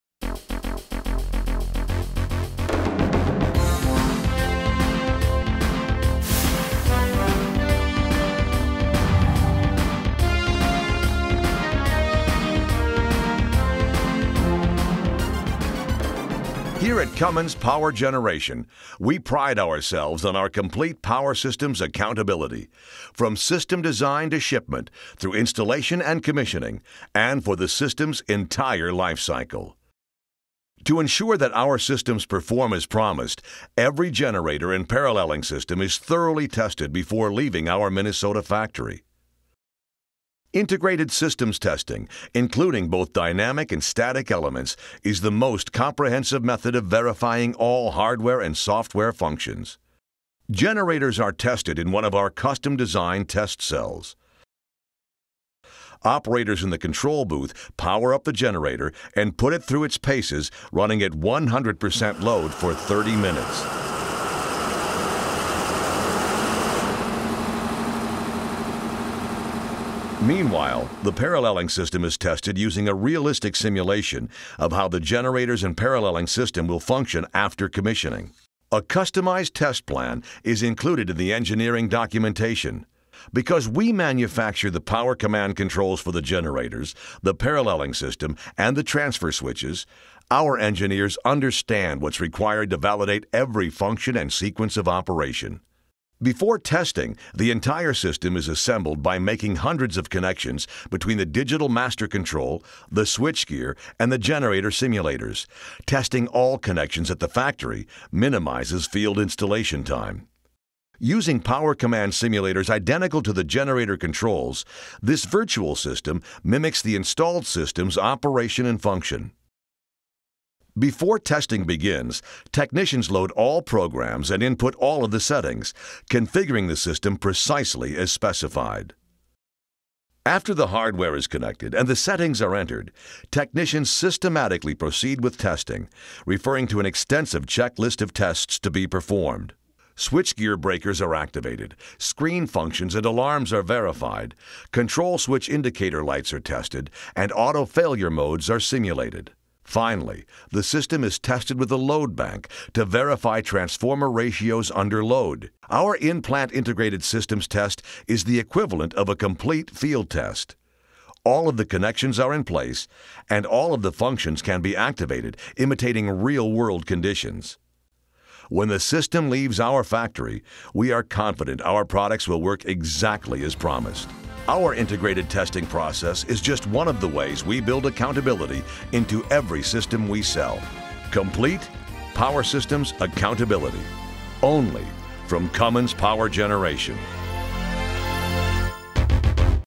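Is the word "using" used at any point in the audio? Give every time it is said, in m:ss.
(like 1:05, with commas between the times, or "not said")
1:12, 1:50.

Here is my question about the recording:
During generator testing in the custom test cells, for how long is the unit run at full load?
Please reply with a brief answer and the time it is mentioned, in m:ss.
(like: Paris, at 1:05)
30 minutes, at 1:02.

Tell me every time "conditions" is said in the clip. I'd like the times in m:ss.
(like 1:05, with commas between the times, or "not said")
2:46.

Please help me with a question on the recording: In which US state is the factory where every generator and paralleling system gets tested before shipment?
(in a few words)
Minnesota.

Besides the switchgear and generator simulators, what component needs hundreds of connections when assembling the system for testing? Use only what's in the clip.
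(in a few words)
digital master control.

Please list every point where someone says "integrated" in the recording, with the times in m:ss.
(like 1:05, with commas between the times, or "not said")
0:40, 2:36, 2:54.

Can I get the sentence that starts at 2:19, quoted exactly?
Switchgear breakers are activated, screen functions and alarms are verified, control switch indicator lights are tested, and auto failure modes are simulated.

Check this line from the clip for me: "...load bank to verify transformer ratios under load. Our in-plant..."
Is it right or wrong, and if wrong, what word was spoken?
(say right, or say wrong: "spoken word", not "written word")
right.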